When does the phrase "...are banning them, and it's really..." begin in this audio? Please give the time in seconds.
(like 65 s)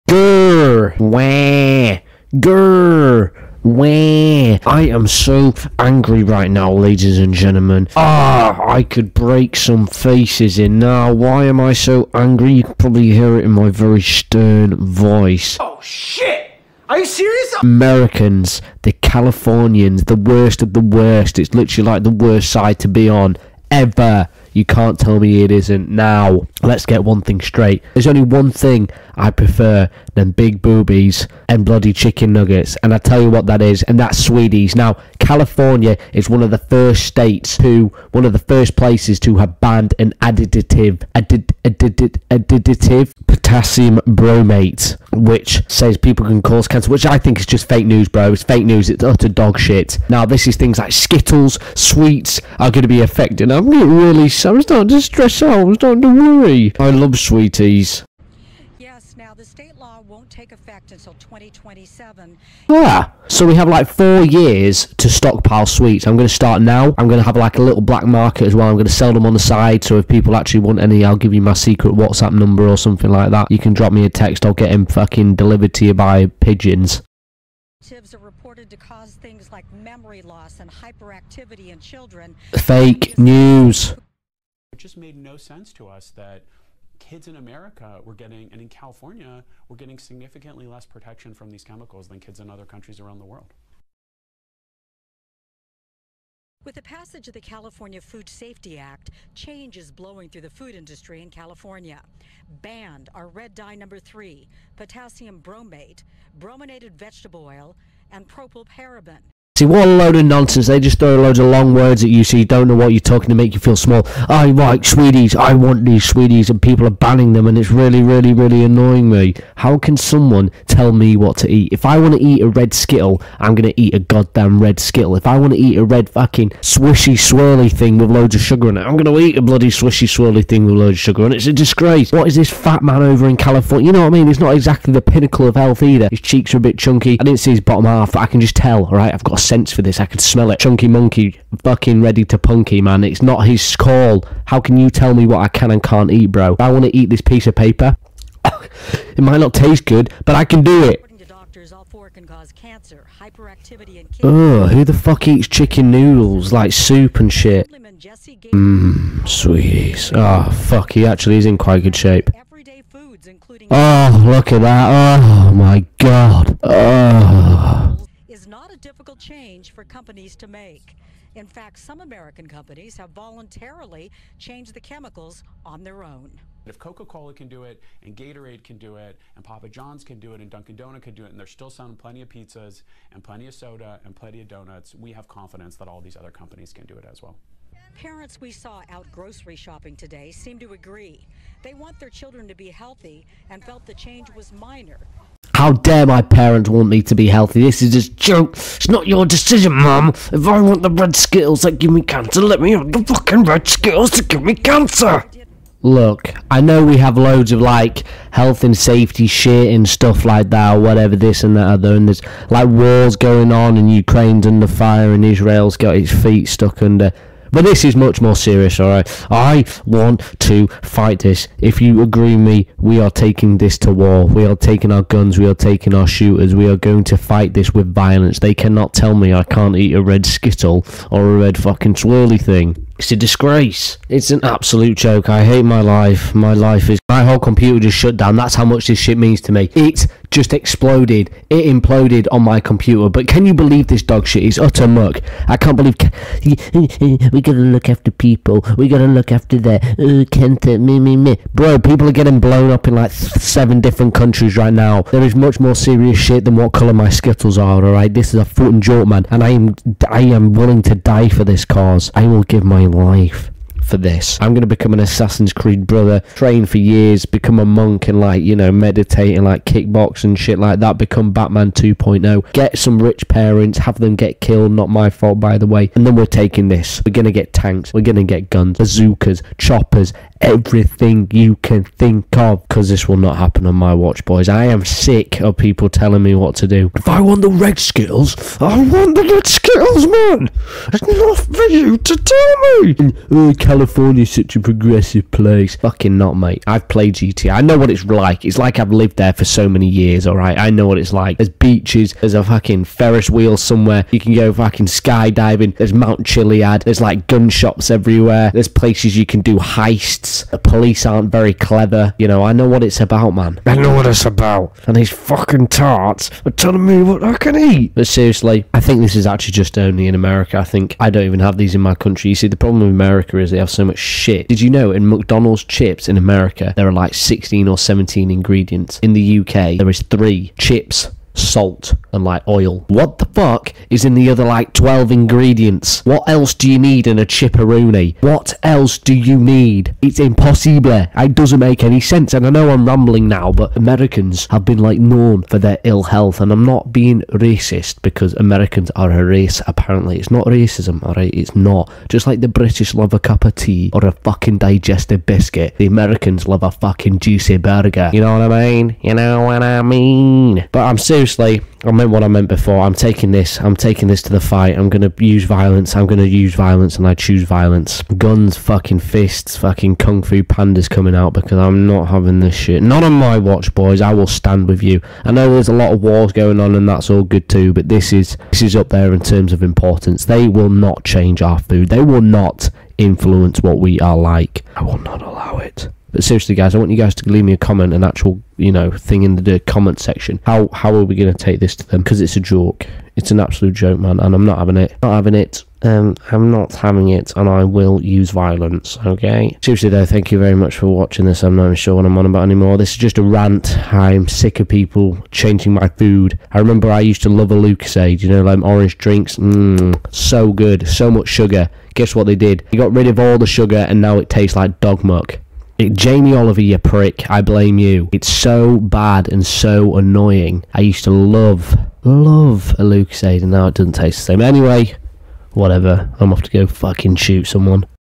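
116 s.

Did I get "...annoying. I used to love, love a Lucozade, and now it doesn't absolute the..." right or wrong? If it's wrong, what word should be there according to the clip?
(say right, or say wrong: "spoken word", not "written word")
wrong: "taste", not "absolute".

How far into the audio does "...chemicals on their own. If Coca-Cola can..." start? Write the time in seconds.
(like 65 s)
174 s.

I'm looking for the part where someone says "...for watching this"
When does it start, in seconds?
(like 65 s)
400 s.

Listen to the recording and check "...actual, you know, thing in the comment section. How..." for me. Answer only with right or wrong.
right.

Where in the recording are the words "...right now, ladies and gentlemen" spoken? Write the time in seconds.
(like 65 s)
6 s.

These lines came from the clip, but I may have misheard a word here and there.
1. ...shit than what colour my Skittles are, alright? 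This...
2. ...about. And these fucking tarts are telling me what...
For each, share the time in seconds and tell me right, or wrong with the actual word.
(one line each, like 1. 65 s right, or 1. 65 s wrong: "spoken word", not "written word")
1. 256 s right
2. 314 s right.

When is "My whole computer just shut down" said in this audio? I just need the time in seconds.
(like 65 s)
237 s.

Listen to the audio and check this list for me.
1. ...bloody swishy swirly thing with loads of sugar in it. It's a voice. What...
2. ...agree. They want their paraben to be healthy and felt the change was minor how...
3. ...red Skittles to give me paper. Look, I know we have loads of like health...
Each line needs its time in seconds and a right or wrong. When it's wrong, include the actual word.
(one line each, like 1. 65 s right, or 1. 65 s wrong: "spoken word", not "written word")
1. 129 s wrong: "disgrace", not "voice"
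2. 190 s wrong: "children", not "paraben"
3. 203 s wrong: "cancer", not "paper".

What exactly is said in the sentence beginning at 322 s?
You see, the problem with America is they have so much shit.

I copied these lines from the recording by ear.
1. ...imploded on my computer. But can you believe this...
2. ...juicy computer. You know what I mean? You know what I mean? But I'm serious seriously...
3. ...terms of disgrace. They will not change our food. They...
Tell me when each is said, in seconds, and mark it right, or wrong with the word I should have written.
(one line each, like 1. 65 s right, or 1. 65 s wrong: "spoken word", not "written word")
1. 241 s right
2. 357 s wrong: "burger", not "computer"
3. 379 s wrong: "importance", not "disgrace".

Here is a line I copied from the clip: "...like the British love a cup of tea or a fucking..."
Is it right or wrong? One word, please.
right.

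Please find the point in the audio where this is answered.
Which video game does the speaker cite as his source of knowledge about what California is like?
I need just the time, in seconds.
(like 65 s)
297 s.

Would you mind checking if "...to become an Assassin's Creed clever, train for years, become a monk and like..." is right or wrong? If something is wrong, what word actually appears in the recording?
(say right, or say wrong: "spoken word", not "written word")
wrong: "brother", not "clever".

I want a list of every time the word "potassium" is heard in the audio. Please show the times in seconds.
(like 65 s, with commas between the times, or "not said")
43 s, 104 s.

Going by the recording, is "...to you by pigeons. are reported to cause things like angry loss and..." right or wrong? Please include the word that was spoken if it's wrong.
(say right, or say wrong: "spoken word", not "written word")
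wrong: "memory", not "angry".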